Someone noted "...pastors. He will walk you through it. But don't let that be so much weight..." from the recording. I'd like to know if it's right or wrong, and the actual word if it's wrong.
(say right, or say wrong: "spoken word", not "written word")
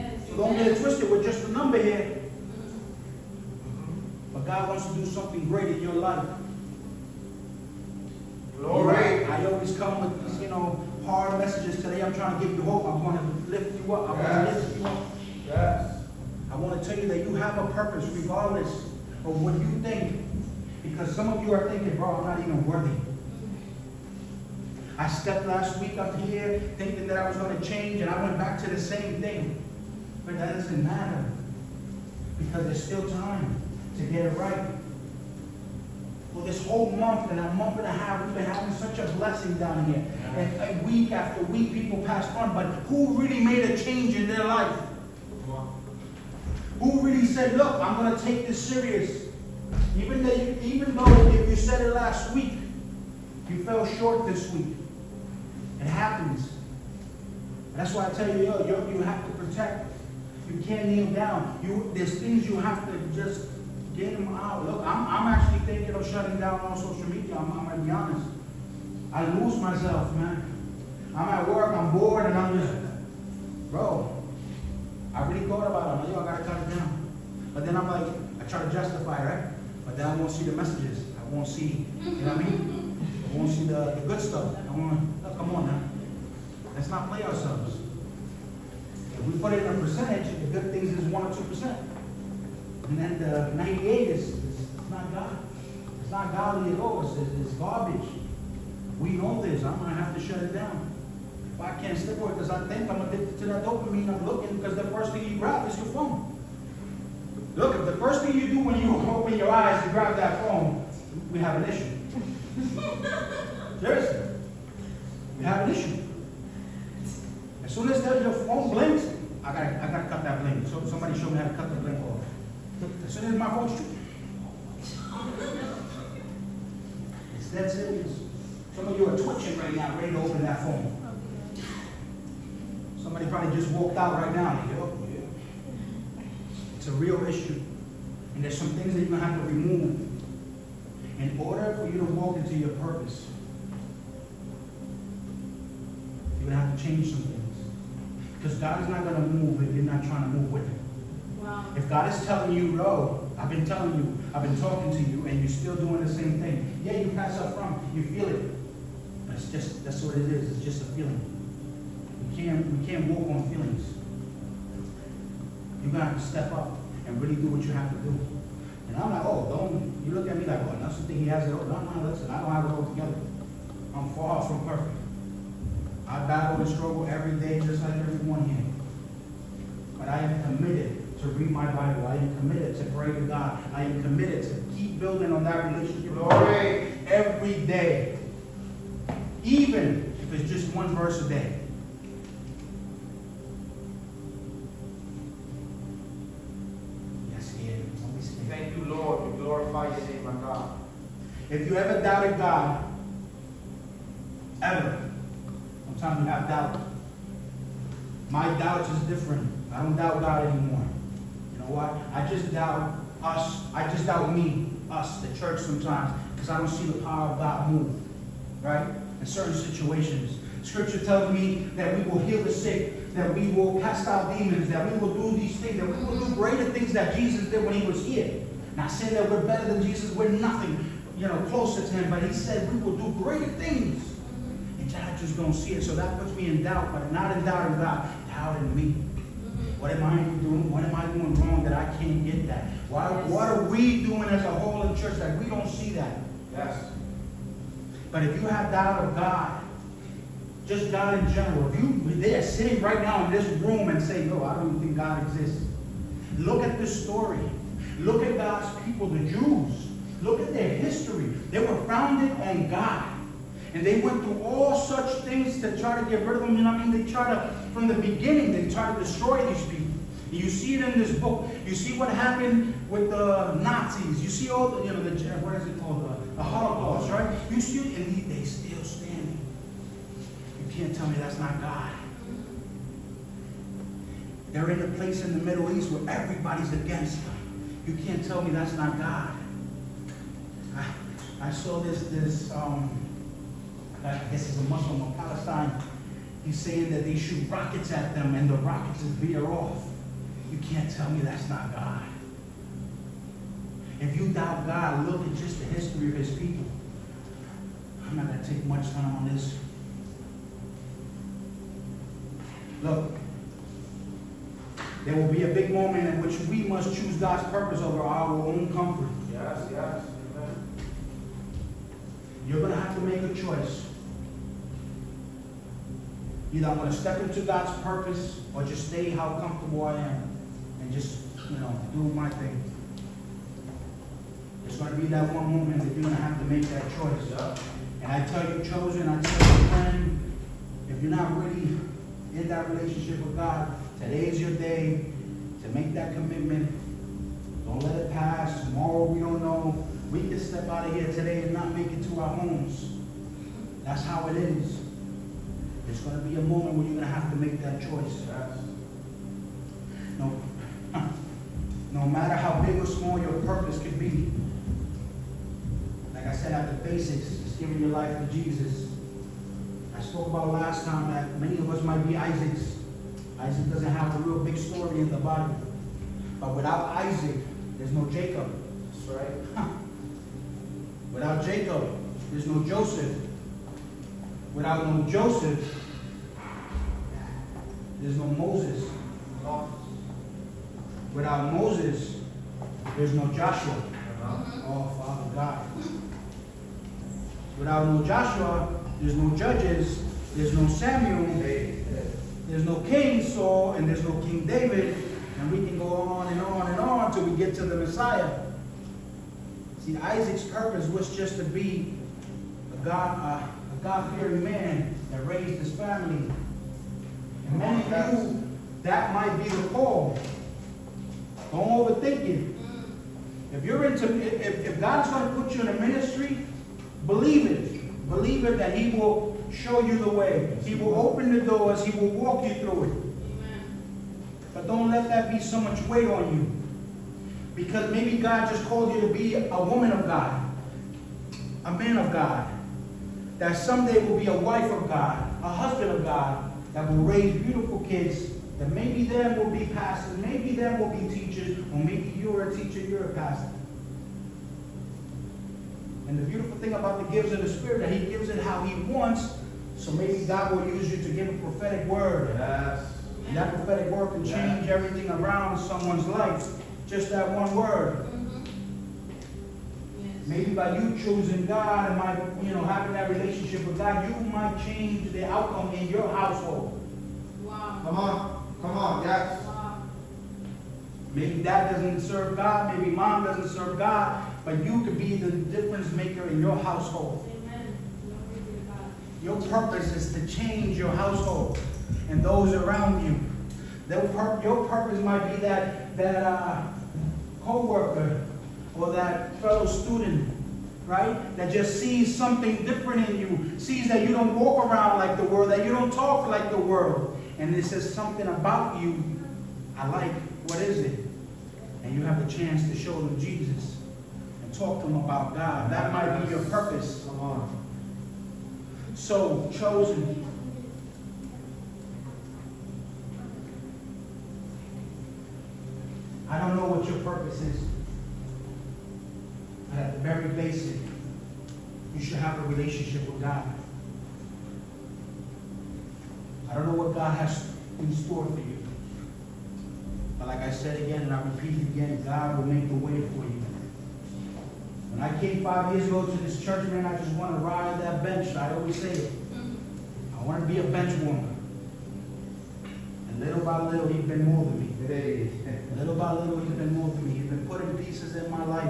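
wrong: "doors", not "pastors".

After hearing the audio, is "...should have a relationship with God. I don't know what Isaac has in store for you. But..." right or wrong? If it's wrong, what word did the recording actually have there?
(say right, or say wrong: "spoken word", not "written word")
wrong: "God", not "Isaac".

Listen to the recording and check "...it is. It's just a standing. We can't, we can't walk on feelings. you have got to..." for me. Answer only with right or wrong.
wrong.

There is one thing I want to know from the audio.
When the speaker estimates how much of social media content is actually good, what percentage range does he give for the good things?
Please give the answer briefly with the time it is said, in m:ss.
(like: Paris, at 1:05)
1 or 2%, at 1:31.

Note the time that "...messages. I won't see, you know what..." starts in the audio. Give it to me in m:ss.
1:20.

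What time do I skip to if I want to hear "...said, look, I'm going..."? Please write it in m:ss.
0:47.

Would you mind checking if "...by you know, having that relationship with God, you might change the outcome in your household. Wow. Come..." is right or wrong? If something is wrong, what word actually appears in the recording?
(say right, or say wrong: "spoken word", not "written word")
right.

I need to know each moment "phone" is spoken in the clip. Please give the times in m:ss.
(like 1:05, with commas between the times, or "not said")
1:45, 1:50, 1:58, 2:03, 2:10.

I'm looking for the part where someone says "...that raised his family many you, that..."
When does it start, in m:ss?
6:55.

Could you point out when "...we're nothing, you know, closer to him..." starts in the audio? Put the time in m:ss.
3:50.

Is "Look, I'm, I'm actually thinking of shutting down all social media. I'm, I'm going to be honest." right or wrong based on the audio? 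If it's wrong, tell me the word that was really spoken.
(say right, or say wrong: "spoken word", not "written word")
right.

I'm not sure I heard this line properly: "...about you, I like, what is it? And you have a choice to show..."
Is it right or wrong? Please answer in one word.
wrong.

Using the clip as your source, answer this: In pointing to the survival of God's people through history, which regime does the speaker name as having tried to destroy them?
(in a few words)
Nazis.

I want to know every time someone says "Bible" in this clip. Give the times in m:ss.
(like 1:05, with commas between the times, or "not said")
3:01, 6:15.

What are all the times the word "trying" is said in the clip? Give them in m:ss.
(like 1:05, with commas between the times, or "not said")
0:12, 2:30.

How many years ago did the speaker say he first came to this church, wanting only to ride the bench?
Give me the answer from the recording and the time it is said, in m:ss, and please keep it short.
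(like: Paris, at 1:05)
5, at 9:05.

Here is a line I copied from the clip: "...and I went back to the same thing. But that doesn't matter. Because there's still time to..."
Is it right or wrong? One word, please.
right.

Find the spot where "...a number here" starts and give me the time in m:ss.
0:01.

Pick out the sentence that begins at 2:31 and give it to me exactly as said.
If God is telling you, no, I've been telling you, I've been talking to you, and you're still doing the same thing.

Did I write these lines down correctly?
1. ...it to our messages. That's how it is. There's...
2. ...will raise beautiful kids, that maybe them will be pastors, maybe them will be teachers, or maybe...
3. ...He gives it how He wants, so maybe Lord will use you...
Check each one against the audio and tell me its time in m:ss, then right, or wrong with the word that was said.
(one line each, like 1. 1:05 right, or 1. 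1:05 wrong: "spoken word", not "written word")
1. 5:51 wrong: "homes", not "messages"
2. 7:26 right
3. 7:37 wrong: "God", not "Lord".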